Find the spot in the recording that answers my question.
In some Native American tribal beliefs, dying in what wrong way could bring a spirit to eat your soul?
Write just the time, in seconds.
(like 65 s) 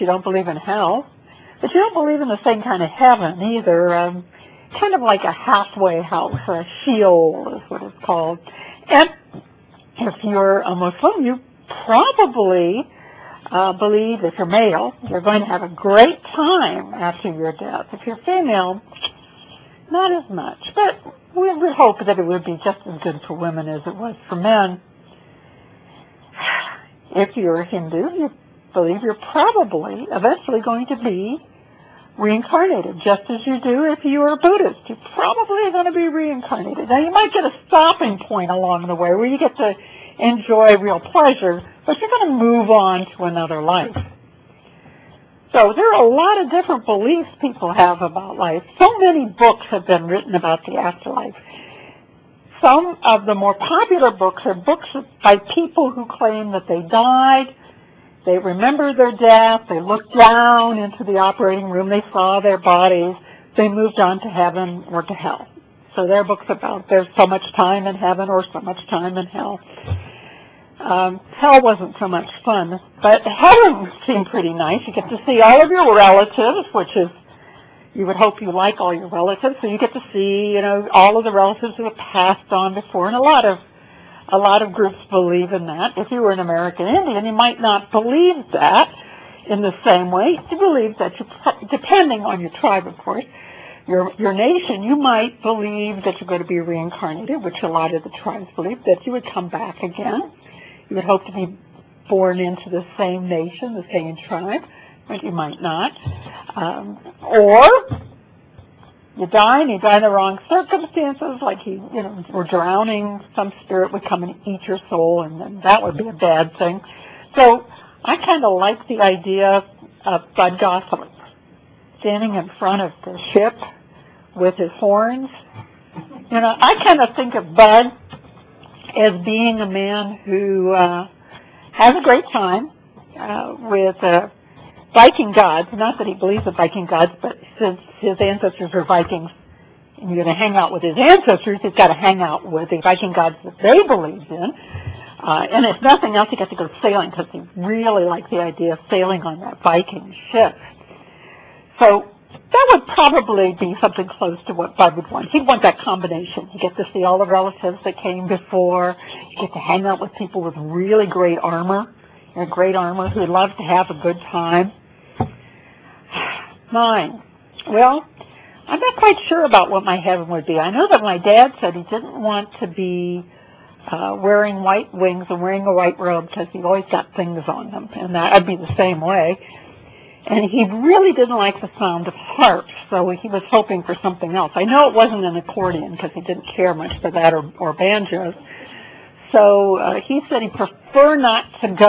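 112 s.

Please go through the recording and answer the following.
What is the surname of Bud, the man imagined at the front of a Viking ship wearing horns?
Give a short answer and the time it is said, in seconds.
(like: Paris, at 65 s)
Gosselin, at 120 s.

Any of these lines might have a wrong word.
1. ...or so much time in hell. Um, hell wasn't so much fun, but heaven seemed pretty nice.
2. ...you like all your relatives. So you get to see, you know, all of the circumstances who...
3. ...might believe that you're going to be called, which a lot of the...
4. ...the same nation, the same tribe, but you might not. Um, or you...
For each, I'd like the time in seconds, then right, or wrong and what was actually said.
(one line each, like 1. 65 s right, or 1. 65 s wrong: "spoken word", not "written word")
1. 68 s right
2. 78 s wrong: "relatives", not "circumstances"
3. 94 s wrong: "reincarnated", not "called"
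4. 102 s right.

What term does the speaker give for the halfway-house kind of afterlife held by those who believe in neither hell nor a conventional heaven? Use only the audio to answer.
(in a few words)
Sheol.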